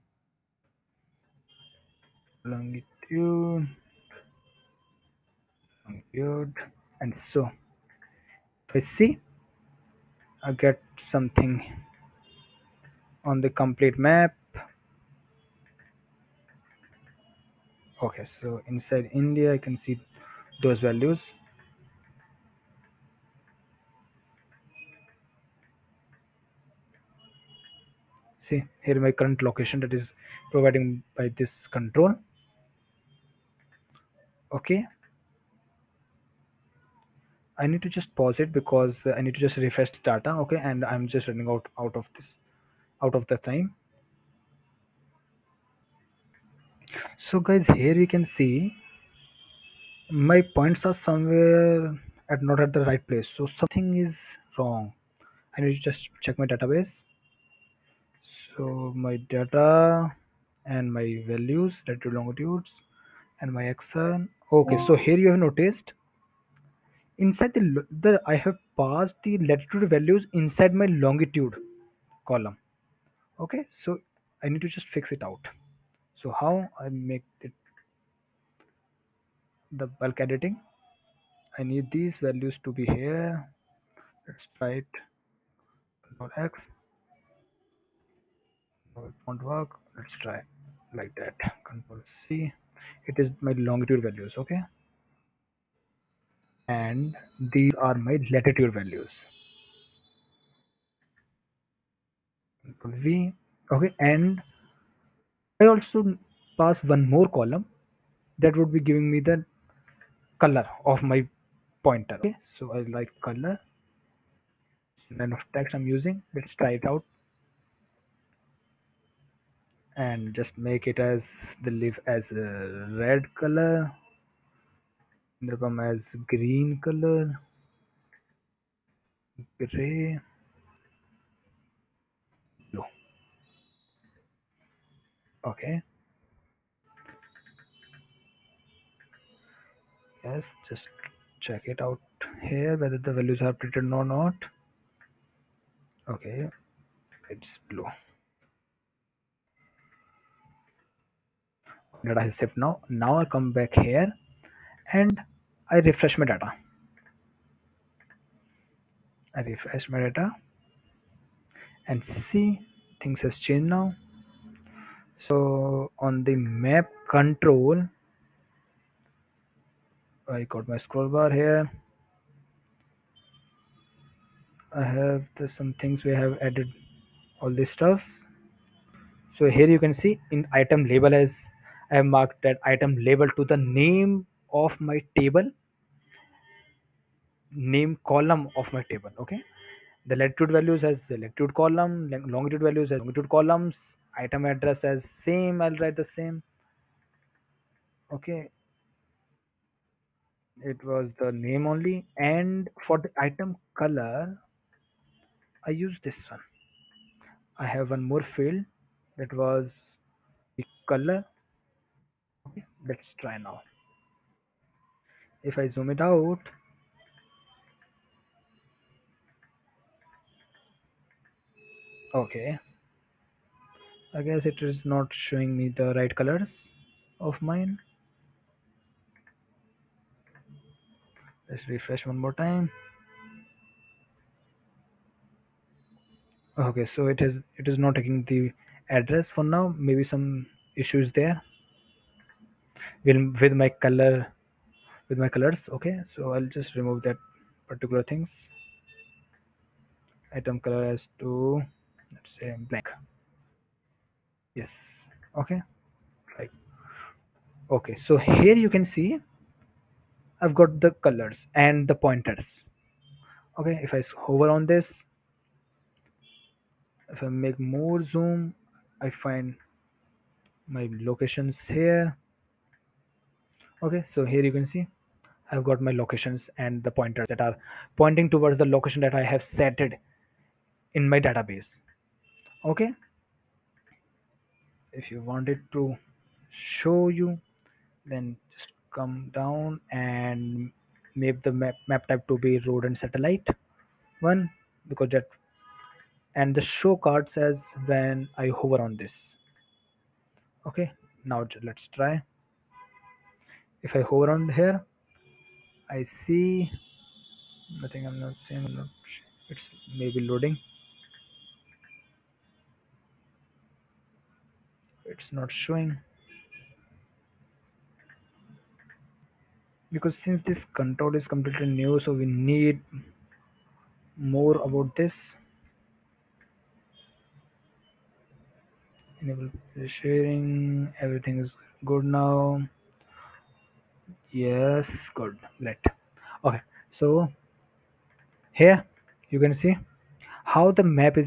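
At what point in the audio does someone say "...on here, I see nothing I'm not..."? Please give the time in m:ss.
5:04.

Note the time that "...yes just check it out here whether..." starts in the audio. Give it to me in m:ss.
2:20.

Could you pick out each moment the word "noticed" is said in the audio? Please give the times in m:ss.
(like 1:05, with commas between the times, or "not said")
1:05.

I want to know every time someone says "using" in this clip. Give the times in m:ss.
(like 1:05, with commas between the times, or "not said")
1:55.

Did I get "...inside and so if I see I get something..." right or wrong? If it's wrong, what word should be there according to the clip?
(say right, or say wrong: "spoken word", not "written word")
wrong: "longitude", not "inside".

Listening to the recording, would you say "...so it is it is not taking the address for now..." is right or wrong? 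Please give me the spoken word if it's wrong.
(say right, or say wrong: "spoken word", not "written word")
right.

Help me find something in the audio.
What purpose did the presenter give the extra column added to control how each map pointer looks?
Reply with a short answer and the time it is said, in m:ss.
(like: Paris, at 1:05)
color of my pointer, at 1:50.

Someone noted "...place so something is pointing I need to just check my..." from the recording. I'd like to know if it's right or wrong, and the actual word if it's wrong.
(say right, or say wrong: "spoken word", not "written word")
wrong: "wrong", not "pointing".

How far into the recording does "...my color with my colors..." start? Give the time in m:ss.
4:03.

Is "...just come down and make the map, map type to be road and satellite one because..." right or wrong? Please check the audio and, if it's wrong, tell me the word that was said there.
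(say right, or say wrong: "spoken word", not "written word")
right.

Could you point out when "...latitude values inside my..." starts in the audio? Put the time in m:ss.
1:09.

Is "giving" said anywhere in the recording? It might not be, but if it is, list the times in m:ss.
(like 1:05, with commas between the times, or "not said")
1:48.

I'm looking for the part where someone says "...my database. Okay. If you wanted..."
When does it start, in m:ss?
4:41.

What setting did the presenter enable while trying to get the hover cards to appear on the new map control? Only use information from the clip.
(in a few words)
sharing.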